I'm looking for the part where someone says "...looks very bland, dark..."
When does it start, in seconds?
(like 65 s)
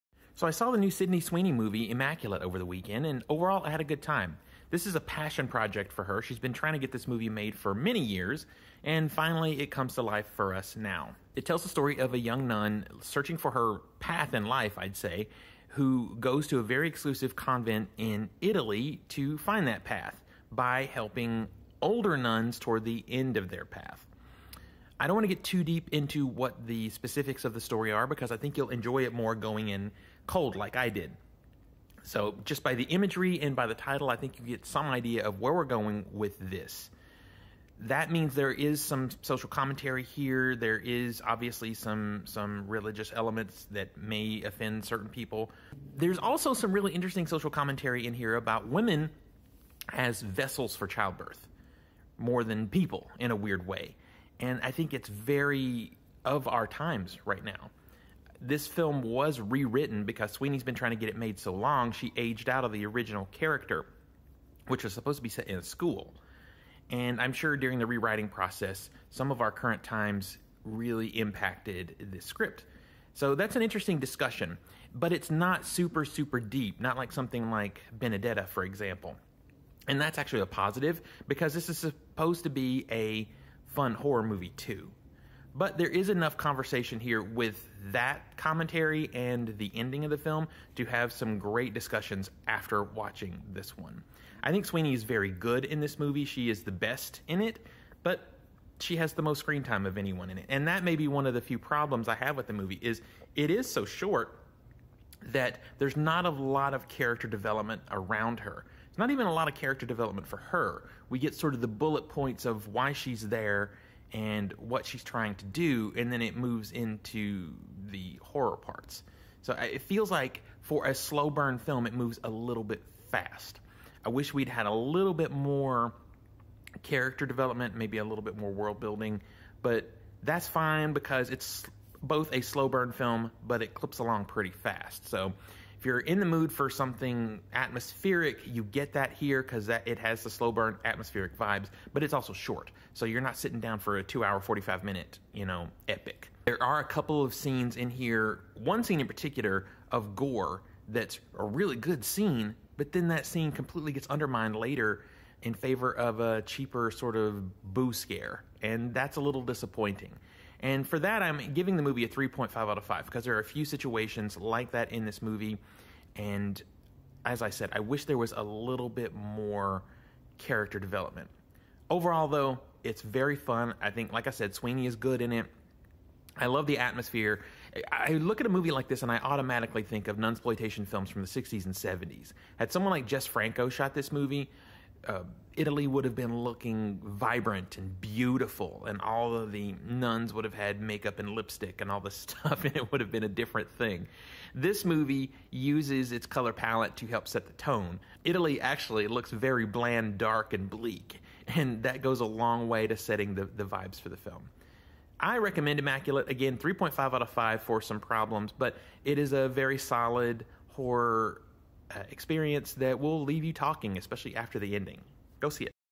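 199 s.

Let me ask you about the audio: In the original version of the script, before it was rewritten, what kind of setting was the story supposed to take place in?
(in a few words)
A school.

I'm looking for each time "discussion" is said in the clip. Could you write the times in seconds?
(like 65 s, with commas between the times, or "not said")
73 s, 91 s.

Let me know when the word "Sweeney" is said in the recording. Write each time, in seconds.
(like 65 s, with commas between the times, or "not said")
1 s, 60 s, 94 s, 174 s.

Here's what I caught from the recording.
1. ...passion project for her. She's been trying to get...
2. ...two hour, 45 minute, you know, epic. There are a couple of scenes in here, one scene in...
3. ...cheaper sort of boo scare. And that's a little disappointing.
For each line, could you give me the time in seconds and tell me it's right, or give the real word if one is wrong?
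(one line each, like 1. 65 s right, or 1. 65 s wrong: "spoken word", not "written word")
1. 4 s right
2. 144 s right
3. 156 s right.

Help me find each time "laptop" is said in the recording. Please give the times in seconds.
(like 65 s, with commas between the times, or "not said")
not said.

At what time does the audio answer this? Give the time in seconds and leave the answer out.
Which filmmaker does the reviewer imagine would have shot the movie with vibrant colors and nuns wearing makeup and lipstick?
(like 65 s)
183 s.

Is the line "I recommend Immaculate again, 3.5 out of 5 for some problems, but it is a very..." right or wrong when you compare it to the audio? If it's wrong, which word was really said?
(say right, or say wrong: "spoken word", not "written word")
right.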